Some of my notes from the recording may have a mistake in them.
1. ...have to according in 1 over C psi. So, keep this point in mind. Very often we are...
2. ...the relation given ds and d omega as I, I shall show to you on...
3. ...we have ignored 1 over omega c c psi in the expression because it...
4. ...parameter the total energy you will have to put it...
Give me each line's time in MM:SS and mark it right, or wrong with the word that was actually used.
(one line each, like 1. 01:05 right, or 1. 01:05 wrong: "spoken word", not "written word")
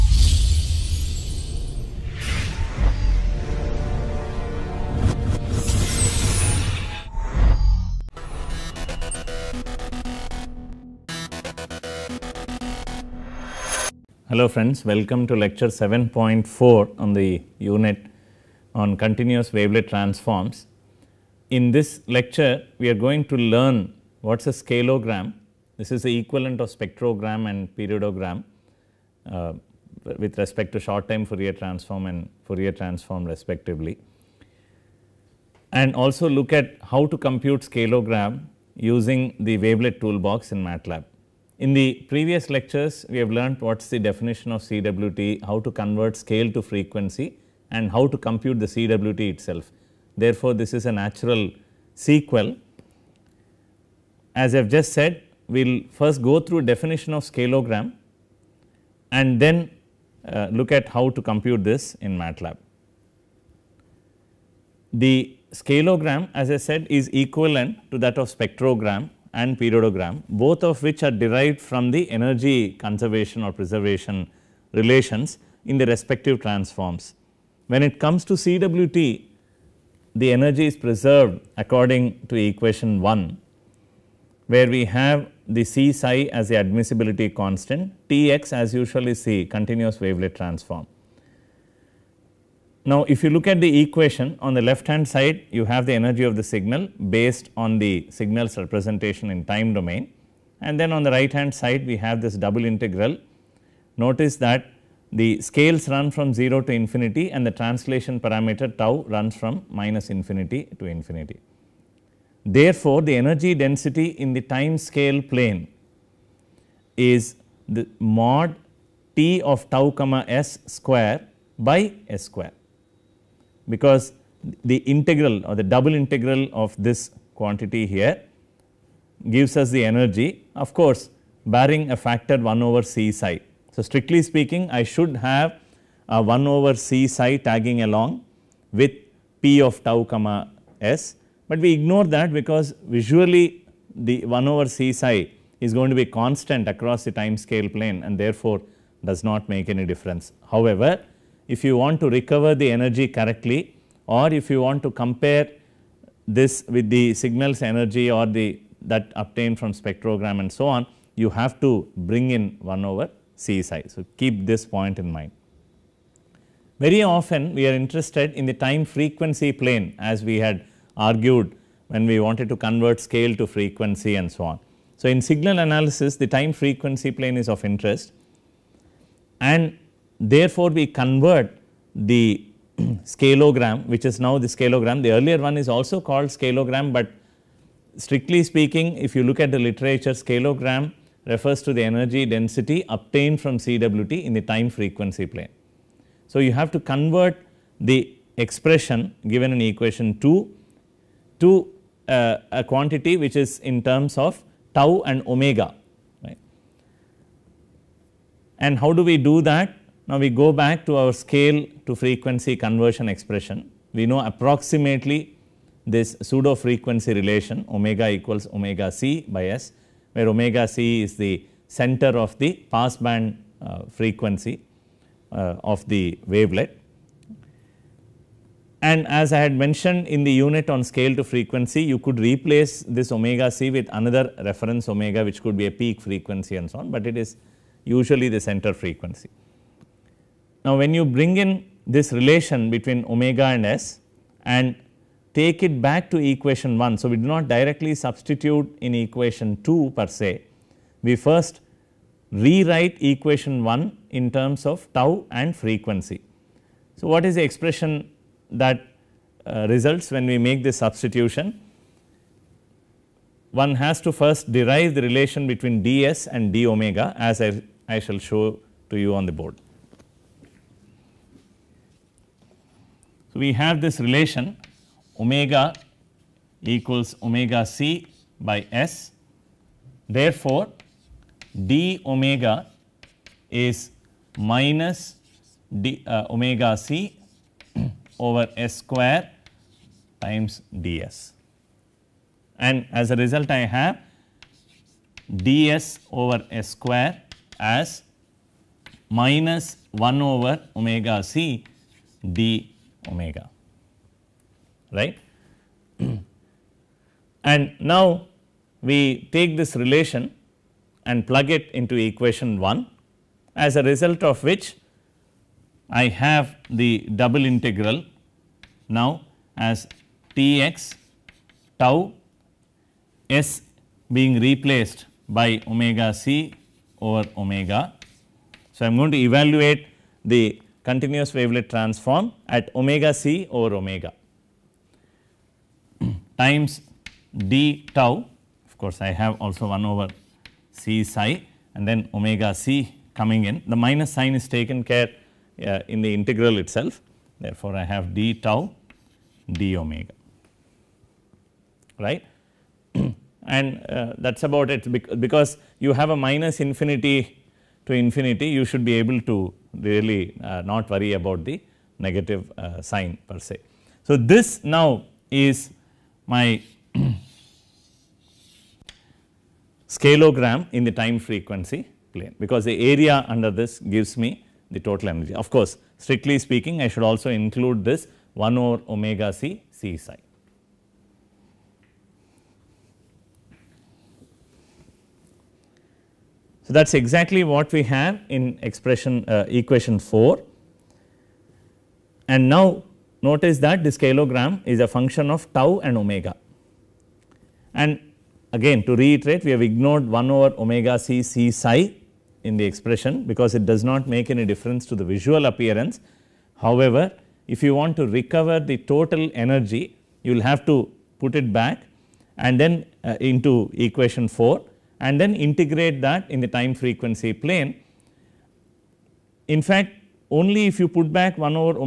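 1. 02:41 wrong: "bring", not "according"
2. 04:24 wrong: "between", not "given"
3. 06:39 right
4. 06:48 wrong: "recover", not "parameter".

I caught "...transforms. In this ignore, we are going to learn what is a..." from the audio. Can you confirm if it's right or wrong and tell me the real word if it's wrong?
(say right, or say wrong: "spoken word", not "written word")
wrong: "lecture", not "ignore".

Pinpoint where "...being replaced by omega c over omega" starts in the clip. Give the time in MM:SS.
05:24.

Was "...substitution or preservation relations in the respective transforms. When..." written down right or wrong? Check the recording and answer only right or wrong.
wrong.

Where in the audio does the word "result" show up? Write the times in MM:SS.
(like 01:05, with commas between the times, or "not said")
04:19, 04:53, 05:13.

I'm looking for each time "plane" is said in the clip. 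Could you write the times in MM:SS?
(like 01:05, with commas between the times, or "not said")
01:55, 02:27, 02:49, 02:57, 03:15, 06:12, 06:57.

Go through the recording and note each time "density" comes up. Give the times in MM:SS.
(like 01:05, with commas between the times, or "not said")
01:53, 03:12.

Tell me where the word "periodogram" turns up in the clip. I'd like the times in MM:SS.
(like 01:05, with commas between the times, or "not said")
00:27, 01:09.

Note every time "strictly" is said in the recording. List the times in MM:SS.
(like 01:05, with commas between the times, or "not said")
02:13, 03:07, 06:15.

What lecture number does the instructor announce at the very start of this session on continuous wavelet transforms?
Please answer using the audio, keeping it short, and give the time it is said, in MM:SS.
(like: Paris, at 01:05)
7.4, at 00:15.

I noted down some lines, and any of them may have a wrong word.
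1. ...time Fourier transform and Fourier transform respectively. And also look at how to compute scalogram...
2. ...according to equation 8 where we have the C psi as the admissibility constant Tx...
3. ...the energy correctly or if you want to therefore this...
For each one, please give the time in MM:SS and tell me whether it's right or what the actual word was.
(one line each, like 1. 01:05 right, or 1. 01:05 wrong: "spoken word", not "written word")
1. 00:31 right
2. 01:21 wrong: "1", not "8"
3. 02:32 wrong: "compare", not "therefore".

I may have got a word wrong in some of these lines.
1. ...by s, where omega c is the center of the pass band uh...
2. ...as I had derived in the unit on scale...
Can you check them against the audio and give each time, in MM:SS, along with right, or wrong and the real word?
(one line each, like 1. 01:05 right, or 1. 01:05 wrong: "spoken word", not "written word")
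1. 03:39 right
2. 03:49 wrong: "mentioned", not "derived".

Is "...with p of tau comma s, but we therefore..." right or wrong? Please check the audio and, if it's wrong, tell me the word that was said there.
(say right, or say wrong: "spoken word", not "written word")
wrong: "ignore", not "therefore".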